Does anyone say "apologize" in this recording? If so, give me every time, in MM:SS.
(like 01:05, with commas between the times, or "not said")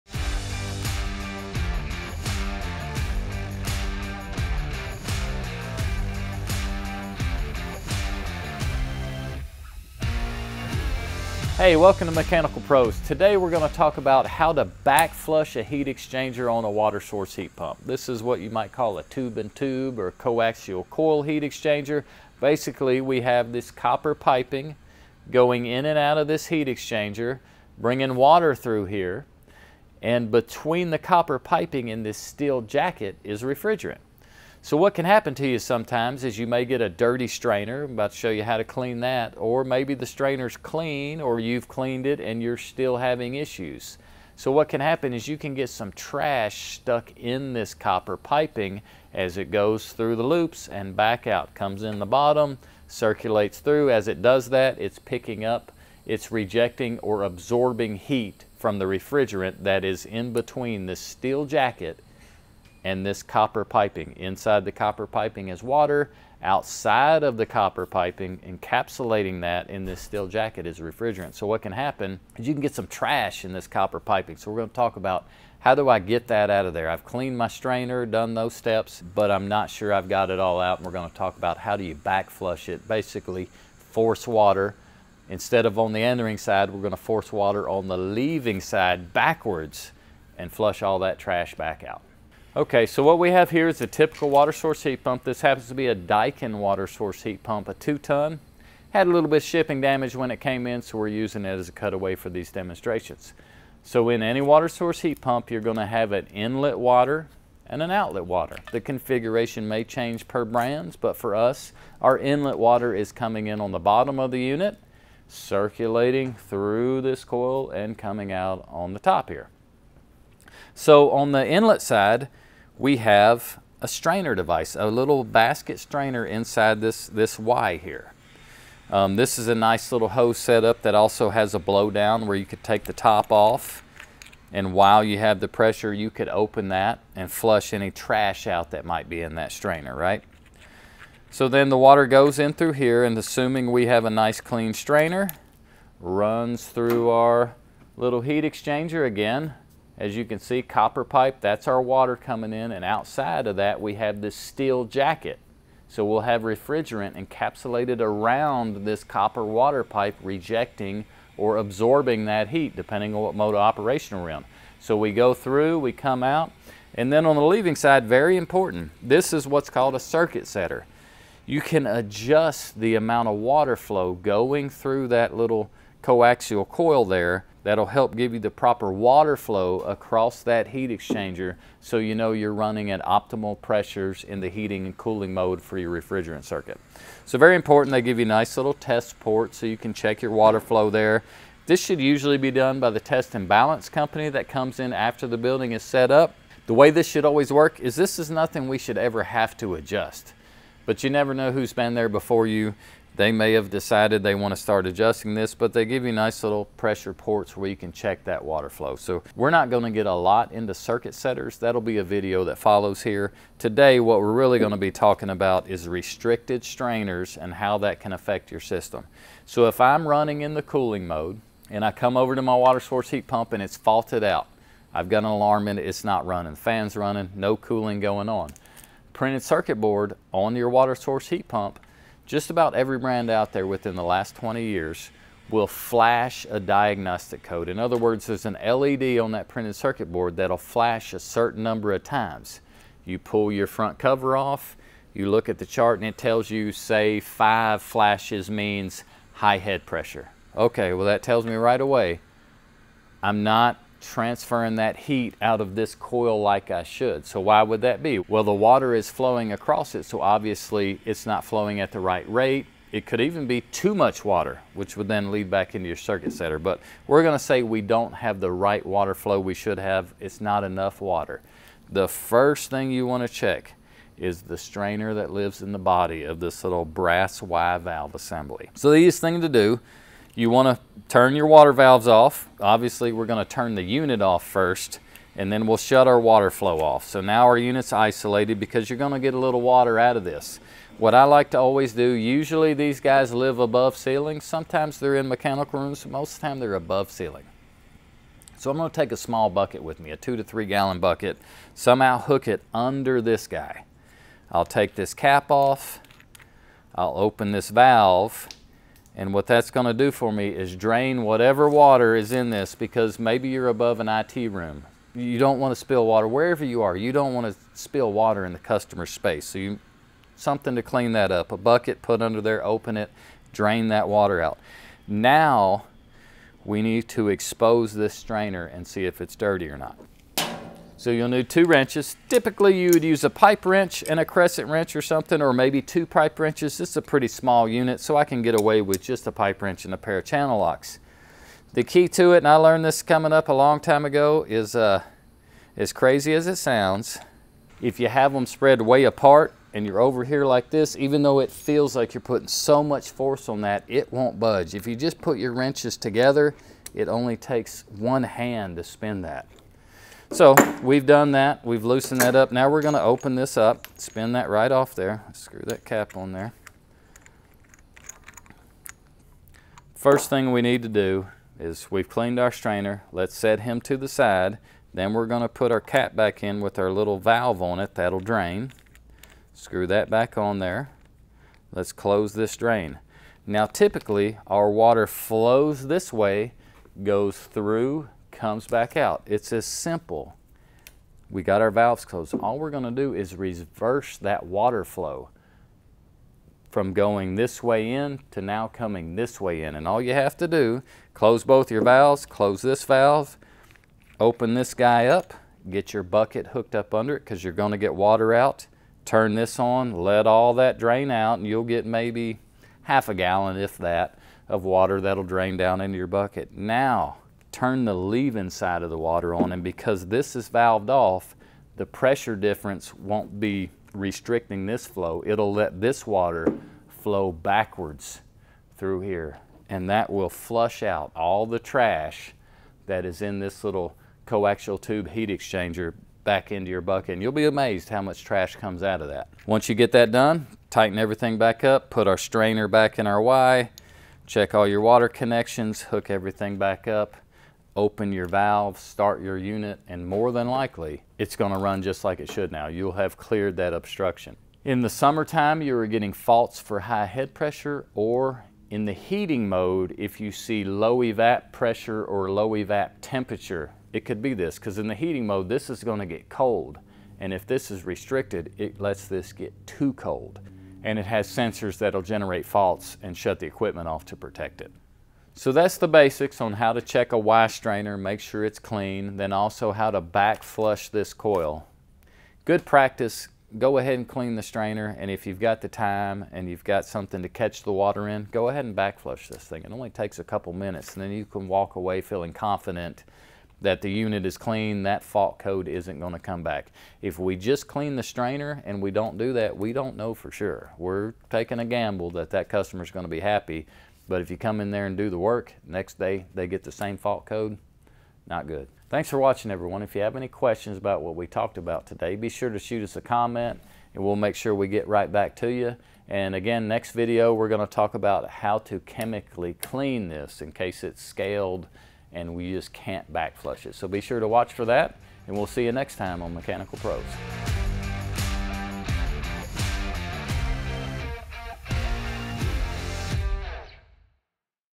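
not said.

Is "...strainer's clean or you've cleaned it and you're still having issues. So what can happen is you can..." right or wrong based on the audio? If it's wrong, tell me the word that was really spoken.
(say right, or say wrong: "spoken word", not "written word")
right.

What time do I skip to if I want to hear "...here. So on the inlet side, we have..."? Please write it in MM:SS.
01:59.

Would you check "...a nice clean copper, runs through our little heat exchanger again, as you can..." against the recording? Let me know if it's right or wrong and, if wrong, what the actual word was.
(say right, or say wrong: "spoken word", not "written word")
wrong: "strainer", not "copper".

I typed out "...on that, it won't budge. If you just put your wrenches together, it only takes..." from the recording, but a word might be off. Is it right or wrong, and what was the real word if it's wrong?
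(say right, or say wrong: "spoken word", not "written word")
right.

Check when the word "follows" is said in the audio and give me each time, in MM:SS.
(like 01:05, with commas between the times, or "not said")
03:32.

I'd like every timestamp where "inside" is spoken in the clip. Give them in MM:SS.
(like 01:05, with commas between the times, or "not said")
01:04, 02:06.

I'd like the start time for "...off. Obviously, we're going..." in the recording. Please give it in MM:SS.
04:42.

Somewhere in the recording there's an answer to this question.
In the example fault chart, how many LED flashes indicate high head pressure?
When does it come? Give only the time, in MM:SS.
04:07.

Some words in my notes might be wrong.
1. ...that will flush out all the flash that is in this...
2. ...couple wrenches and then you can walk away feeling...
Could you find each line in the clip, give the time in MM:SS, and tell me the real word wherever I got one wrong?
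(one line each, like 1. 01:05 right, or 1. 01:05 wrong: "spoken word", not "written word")
1. 07:09 wrong: "trash", not "flash"
2. 08:10 wrong: "minutes", not "wrenches".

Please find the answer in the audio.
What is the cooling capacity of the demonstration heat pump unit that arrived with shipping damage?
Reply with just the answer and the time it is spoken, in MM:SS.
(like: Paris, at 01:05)
2 ton, at 01:37.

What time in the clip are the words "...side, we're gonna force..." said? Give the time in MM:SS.
01:26.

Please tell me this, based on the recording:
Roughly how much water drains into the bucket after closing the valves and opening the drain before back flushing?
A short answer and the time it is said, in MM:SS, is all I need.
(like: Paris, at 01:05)
half a gallon, at 06:52.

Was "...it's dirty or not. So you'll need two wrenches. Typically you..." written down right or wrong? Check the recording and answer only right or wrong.
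right.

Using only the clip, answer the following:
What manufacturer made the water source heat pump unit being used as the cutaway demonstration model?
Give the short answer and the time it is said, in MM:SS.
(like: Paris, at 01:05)
Daikin, at 01:35.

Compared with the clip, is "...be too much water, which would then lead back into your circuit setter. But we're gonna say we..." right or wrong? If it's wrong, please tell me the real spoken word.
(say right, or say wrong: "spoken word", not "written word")
right.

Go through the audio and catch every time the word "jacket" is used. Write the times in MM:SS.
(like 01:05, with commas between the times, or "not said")
00:32, 01:01, 01:10, 02:34.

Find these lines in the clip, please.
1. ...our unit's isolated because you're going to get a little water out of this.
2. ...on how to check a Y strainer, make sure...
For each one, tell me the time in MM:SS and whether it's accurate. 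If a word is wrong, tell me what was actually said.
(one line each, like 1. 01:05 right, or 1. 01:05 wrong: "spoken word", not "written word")
1. 04:47 right
2. 07:56 right.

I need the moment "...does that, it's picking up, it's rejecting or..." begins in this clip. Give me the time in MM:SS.
00:54.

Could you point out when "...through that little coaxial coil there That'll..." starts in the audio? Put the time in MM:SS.
02:54.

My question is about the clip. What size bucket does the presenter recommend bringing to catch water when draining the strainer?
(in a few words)
2 to 3 gallon.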